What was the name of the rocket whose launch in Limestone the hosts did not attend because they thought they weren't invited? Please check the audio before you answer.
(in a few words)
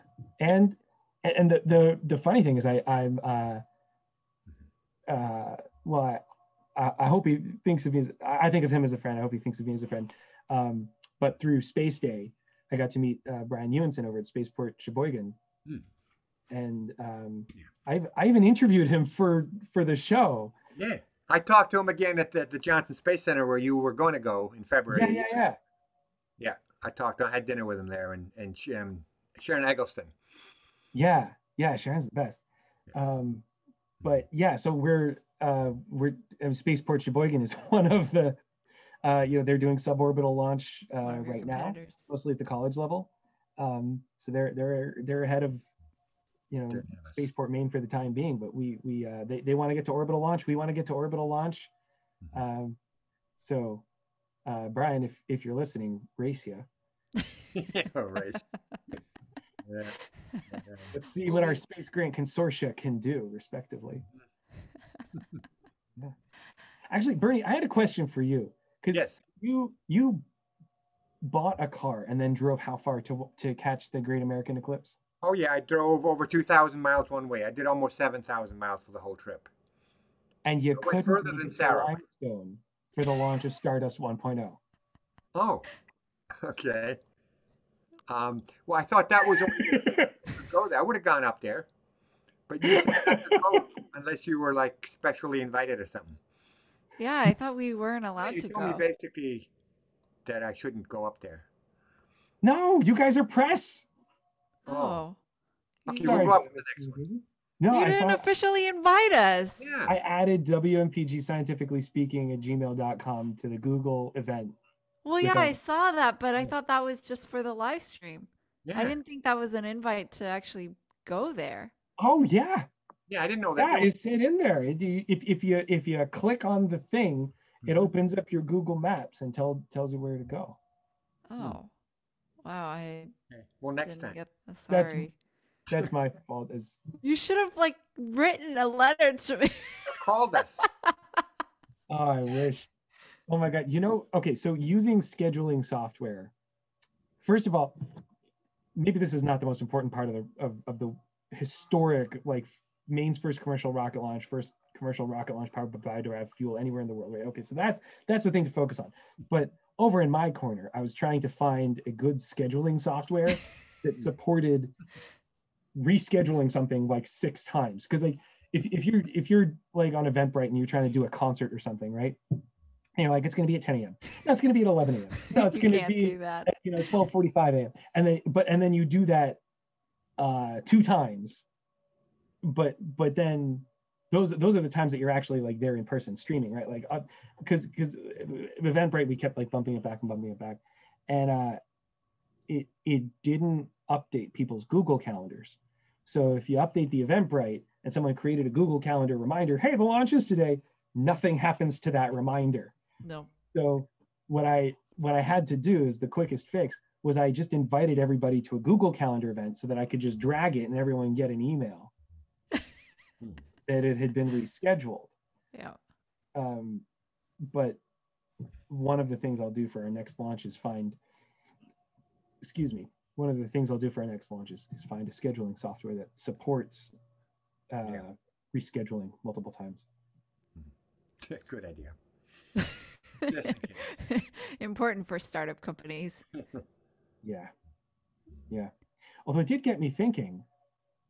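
Stardust 1.0.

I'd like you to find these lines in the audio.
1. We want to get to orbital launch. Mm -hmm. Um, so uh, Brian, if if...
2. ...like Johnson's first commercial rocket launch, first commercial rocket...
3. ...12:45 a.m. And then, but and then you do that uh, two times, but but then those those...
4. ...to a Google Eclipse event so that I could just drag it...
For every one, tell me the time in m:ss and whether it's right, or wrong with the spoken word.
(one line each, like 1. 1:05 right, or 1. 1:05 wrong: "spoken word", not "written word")
1. 0:50 right
2. 2:32 wrong: "Maine", not "Johnson"
3. 2:56 right
4. 3:28 wrong: "Calendar", not "Eclipse".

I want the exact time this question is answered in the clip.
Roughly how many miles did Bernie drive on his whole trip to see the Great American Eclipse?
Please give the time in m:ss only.
1:17.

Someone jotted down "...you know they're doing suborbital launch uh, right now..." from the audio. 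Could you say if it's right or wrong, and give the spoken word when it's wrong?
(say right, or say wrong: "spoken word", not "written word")
right.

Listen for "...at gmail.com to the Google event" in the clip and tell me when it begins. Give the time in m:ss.
1:52.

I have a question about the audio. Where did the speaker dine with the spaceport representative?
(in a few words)
Johnson Space Center.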